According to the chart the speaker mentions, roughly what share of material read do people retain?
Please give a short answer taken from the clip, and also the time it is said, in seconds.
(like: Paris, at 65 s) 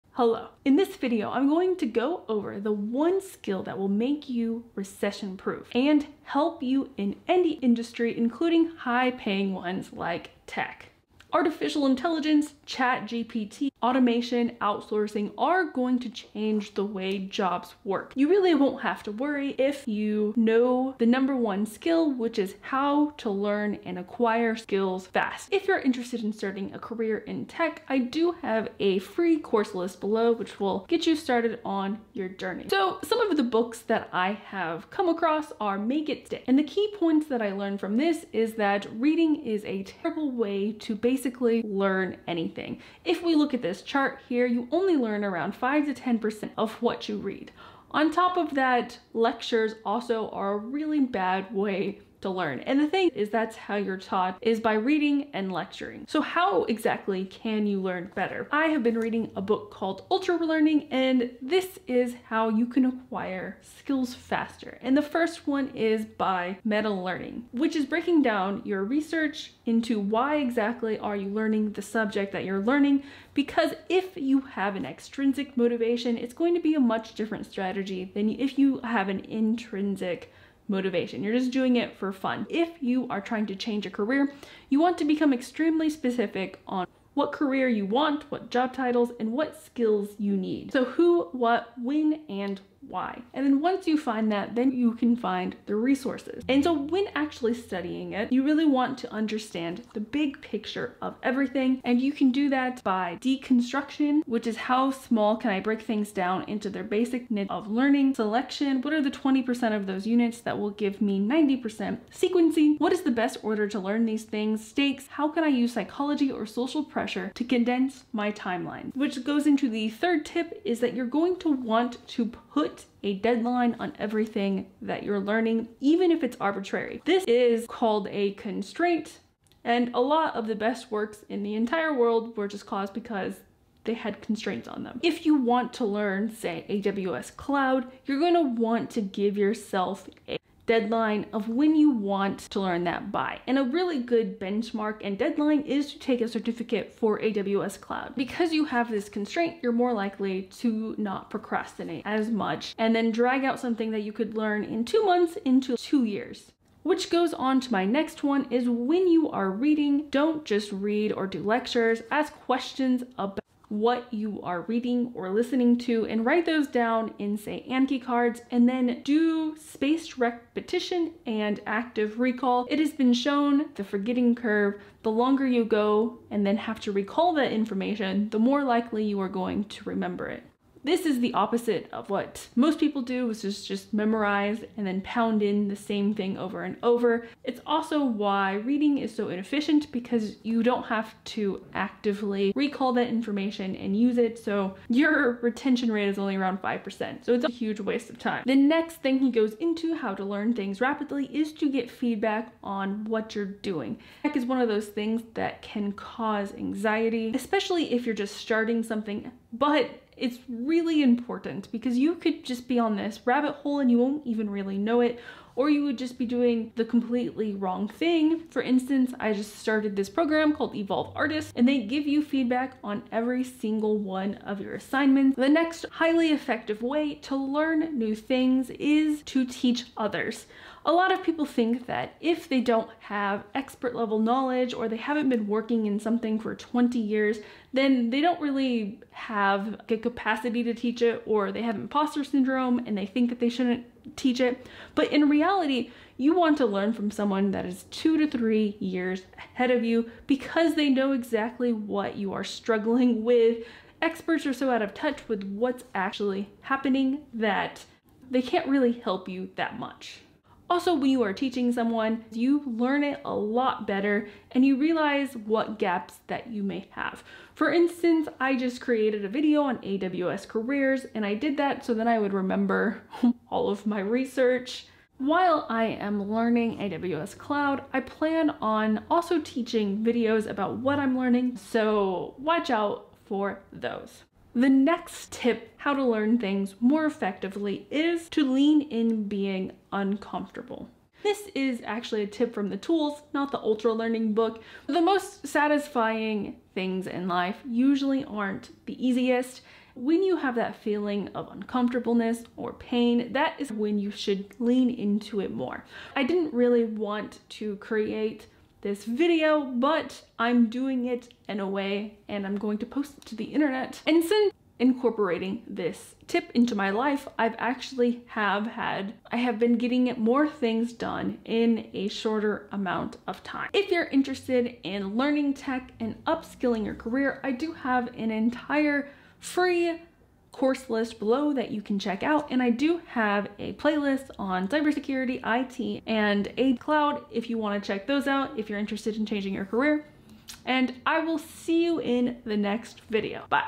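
5 to 10%, at 45 s.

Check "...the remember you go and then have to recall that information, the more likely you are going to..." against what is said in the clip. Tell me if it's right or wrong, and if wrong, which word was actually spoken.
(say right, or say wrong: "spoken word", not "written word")
wrong: "longer", not "remember".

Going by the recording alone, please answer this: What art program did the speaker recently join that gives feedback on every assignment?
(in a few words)
Evolve Artist.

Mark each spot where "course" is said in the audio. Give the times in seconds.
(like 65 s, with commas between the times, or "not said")
29 s, 330 s.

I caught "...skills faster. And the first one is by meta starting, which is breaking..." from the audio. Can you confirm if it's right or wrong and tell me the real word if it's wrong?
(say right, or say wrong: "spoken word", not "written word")
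wrong: "learning", not "starting".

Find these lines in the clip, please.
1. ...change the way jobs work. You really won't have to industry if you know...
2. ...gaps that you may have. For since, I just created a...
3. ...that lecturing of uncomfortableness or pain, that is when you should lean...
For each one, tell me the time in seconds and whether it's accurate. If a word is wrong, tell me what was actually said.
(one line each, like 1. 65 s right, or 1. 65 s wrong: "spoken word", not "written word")
1. 16 s wrong: "worry", not "industry"
2. 265 s wrong: "instance", not "since"
3. 300 s wrong: "feeling", not "lecturing".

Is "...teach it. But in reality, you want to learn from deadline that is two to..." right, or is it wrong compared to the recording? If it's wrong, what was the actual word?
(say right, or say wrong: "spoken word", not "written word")
wrong: "someone", not "deadline".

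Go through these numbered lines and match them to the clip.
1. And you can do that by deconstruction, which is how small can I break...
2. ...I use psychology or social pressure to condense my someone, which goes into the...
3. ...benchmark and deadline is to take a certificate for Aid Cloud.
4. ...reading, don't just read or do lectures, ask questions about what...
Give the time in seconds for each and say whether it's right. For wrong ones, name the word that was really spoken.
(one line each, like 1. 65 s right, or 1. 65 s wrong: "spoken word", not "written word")
1. 101 s right
2. 115 s wrong: "timeline", not "someone"
3. 144 s wrong: "AWS", not "Aid"
4. 159 s right.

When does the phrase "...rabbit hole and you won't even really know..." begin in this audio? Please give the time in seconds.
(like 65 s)
213 s.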